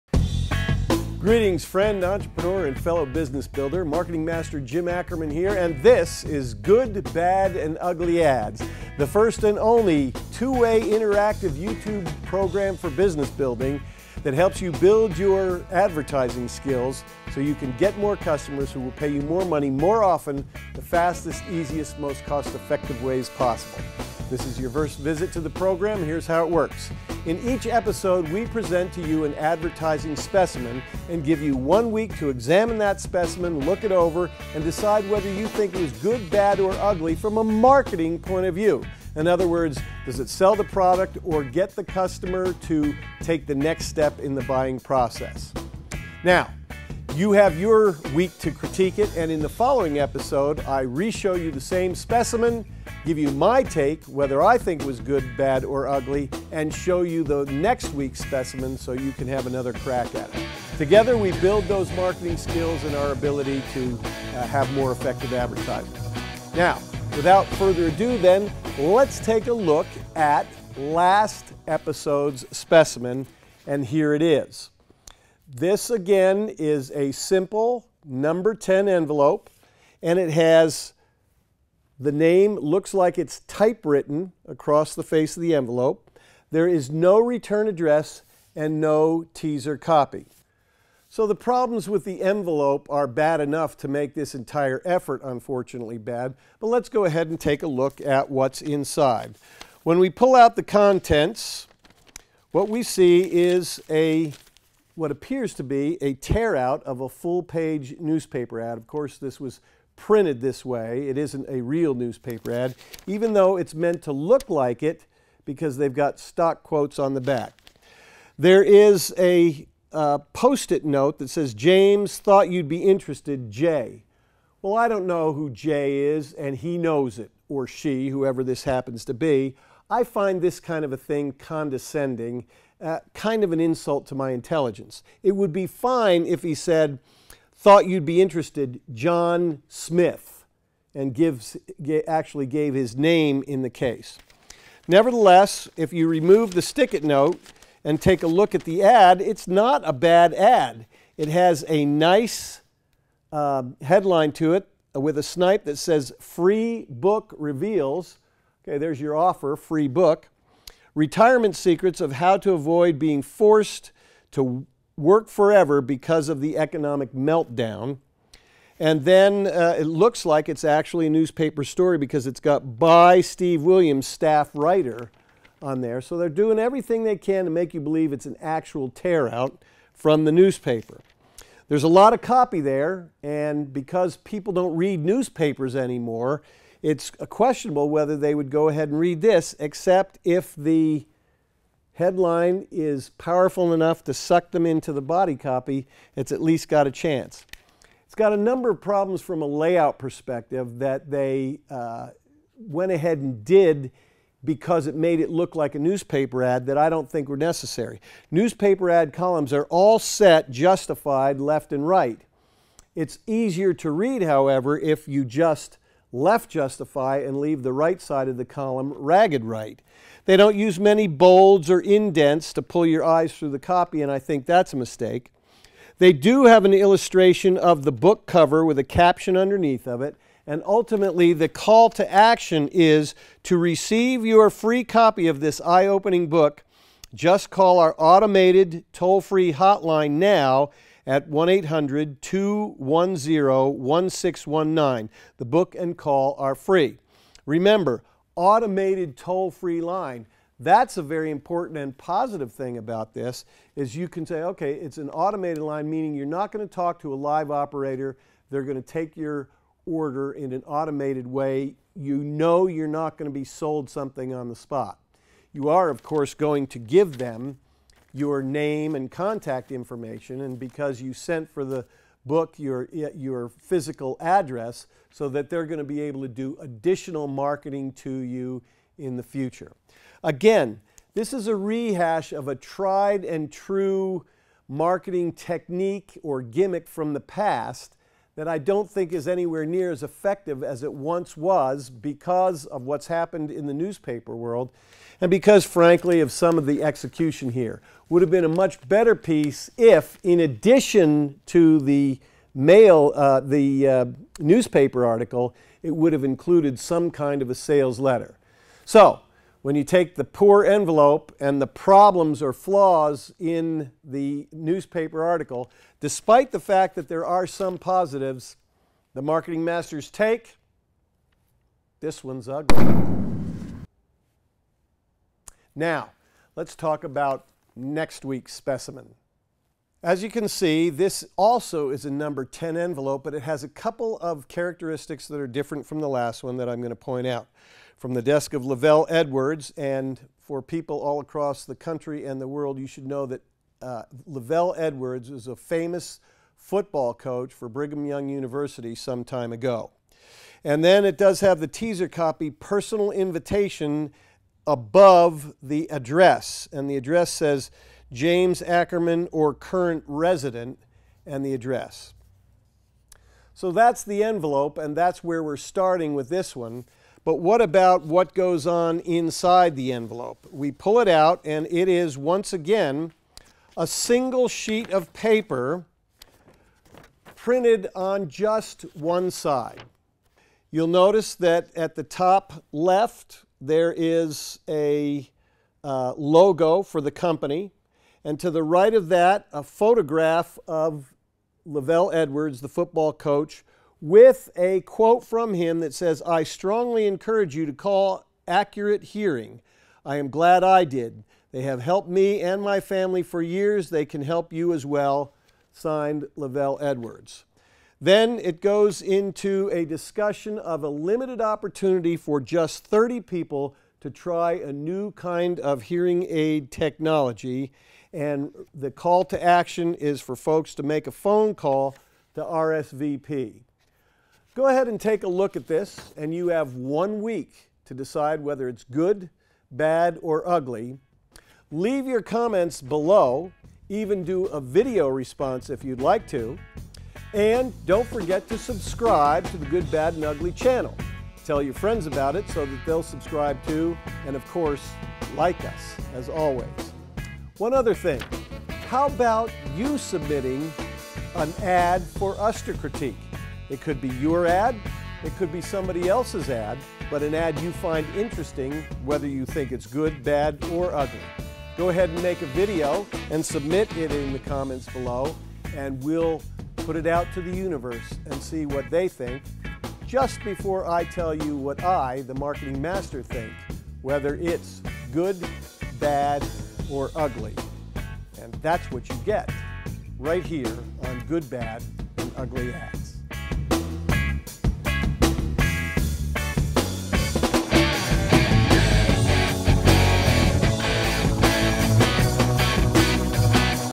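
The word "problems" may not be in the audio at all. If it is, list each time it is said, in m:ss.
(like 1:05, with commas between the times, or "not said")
1:31, 3:18, 5:11.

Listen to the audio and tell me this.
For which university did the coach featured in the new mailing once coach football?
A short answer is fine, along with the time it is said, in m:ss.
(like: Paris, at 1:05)
Brigham Young University, at 5:47.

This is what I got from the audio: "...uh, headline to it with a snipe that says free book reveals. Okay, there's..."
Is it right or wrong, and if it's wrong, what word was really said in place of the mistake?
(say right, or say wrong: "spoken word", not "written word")
right.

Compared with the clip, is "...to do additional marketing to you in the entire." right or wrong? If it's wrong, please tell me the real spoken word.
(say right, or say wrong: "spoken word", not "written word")
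wrong: "future", not "entire".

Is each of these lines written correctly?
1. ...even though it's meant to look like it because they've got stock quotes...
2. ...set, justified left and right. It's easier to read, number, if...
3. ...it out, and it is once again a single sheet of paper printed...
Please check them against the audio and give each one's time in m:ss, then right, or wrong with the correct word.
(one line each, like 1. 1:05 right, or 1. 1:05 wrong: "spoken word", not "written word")
1. 1:53 right
2. 3:29 wrong: "however", not "number"
3. 6:10 right.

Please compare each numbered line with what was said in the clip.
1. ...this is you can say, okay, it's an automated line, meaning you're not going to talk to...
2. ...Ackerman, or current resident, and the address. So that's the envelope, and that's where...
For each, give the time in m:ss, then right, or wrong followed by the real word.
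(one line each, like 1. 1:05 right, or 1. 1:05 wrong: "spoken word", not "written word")
1. 4:13 right
2. 5:58 right.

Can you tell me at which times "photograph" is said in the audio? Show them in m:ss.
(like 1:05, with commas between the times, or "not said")
6:29.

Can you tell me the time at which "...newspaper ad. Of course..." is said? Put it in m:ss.
1:47.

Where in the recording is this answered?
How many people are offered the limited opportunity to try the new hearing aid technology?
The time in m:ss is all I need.
6:52.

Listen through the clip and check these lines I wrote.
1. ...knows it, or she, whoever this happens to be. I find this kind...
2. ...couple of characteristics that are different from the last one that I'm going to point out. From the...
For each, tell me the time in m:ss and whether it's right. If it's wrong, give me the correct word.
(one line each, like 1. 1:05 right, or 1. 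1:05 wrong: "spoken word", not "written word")
1. 2:06 right
2. 5:33 right.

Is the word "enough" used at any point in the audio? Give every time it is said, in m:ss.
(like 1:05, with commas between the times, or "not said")
1:33, 3:13.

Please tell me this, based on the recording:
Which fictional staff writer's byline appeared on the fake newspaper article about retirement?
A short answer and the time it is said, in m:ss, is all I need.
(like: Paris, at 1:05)
Steve Williams, at 2:53.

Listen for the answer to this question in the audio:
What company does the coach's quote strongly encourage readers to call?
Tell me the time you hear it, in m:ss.
6:38.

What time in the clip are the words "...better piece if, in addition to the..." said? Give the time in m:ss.
4:58.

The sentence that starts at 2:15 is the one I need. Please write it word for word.
It would be fine if he said, Thought you'd be interested, John Smith, and gives, actually gave his name in the case.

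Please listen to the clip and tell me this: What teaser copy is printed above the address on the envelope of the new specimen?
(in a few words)
personal invitation.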